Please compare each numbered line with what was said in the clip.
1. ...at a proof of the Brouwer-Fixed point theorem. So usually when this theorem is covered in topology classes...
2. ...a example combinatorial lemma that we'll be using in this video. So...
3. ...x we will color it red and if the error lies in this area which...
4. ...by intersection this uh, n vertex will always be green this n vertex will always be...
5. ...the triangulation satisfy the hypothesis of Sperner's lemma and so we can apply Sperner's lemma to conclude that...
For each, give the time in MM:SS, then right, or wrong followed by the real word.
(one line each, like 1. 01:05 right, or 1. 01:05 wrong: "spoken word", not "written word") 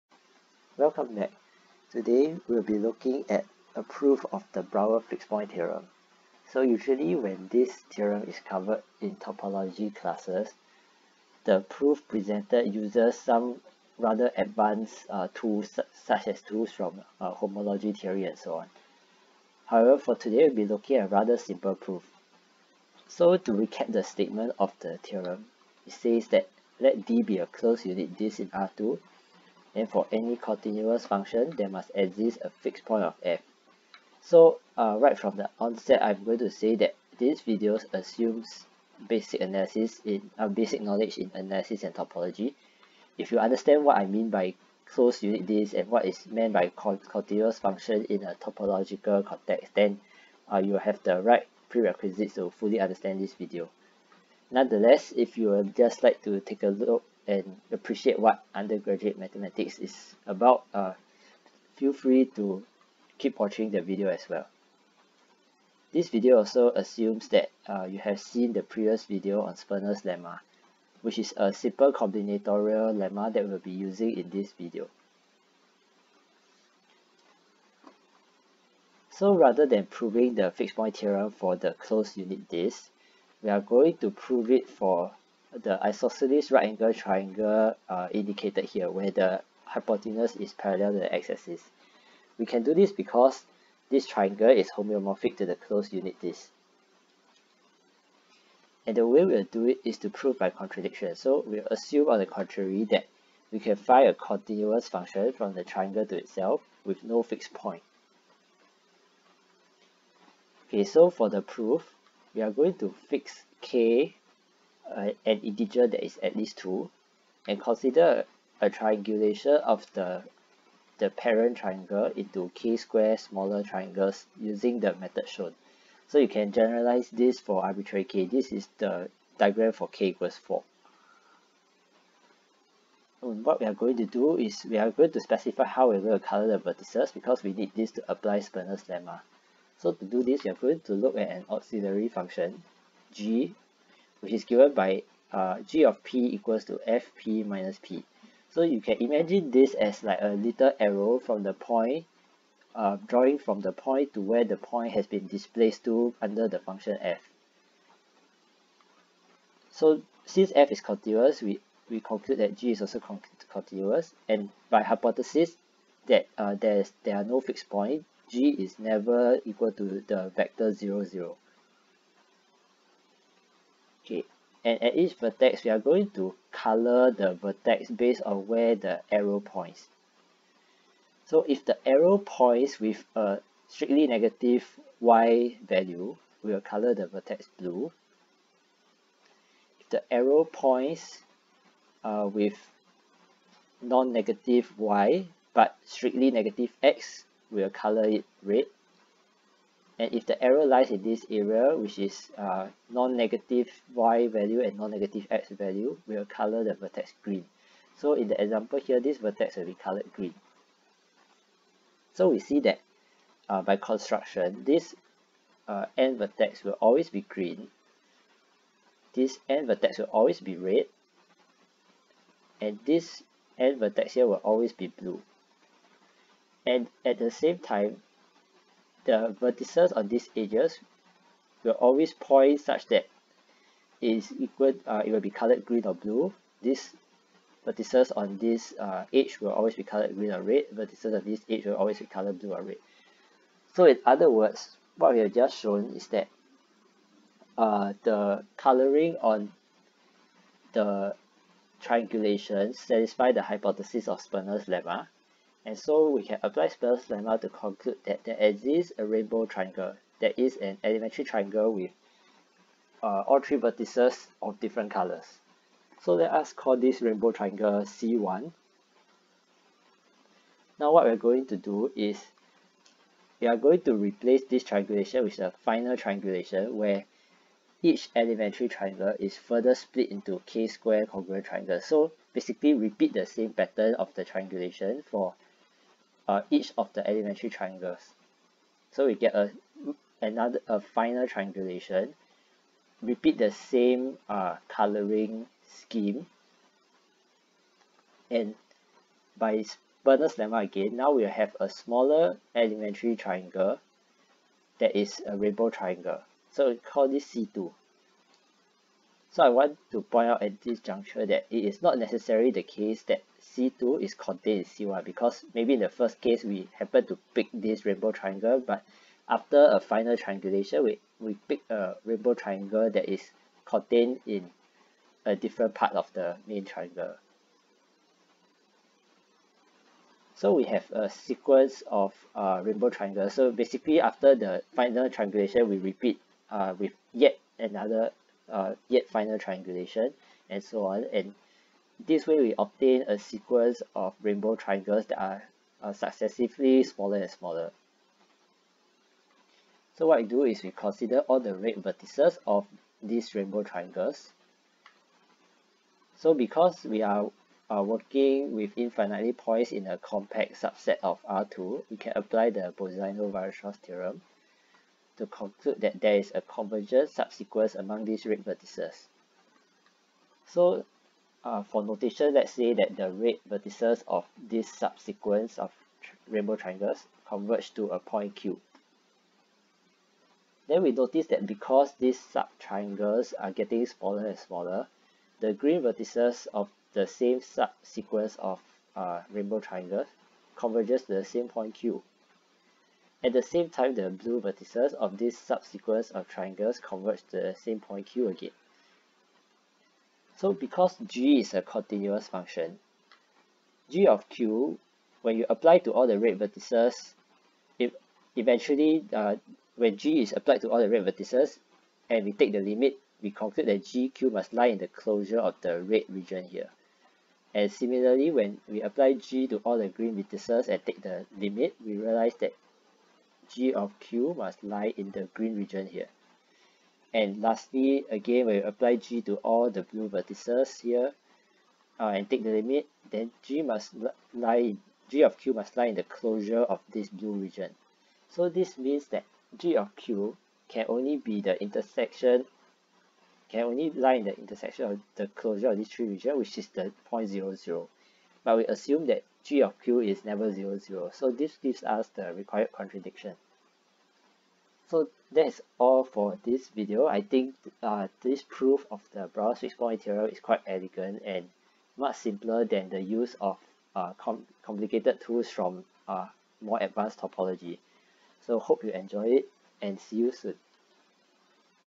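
1. 00:03 right
2. 01:11 wrong: "simple", not "example"
3. 03:16 right
4. 03:33 wrong: "construction", not "intersection"
5. 04:10 right.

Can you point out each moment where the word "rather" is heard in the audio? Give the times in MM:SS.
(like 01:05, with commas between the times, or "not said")
00:13, 00:21, 01:19.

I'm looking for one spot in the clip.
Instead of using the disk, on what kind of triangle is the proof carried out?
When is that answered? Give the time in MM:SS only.
01:25.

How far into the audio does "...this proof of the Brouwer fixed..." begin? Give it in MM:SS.
07:38.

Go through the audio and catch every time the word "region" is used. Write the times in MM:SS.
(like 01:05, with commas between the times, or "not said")
06:56, 07:05, 07:17, 07:26.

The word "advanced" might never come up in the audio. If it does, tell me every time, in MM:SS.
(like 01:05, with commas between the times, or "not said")
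00:14, 07:46.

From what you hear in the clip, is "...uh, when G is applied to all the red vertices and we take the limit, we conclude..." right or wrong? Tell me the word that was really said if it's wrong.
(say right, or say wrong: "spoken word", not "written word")
right.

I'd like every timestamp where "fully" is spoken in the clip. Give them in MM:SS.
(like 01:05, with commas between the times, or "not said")
00:52.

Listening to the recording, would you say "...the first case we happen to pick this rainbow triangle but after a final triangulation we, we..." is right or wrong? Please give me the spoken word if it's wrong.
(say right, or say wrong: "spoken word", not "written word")
right.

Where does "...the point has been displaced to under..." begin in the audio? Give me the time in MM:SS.
02:34.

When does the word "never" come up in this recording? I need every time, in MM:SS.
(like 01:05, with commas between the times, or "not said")
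02:48, 07:30.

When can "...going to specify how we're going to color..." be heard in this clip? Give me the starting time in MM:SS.
02:14.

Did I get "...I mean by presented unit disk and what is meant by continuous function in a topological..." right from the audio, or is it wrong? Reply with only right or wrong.
wrong.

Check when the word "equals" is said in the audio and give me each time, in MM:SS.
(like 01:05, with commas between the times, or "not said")
02:10, 02:26, 02:49, 03:54.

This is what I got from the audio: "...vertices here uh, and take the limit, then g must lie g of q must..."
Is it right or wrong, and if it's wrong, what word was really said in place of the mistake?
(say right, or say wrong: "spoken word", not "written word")
right.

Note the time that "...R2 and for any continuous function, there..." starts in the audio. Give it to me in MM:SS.
00:28.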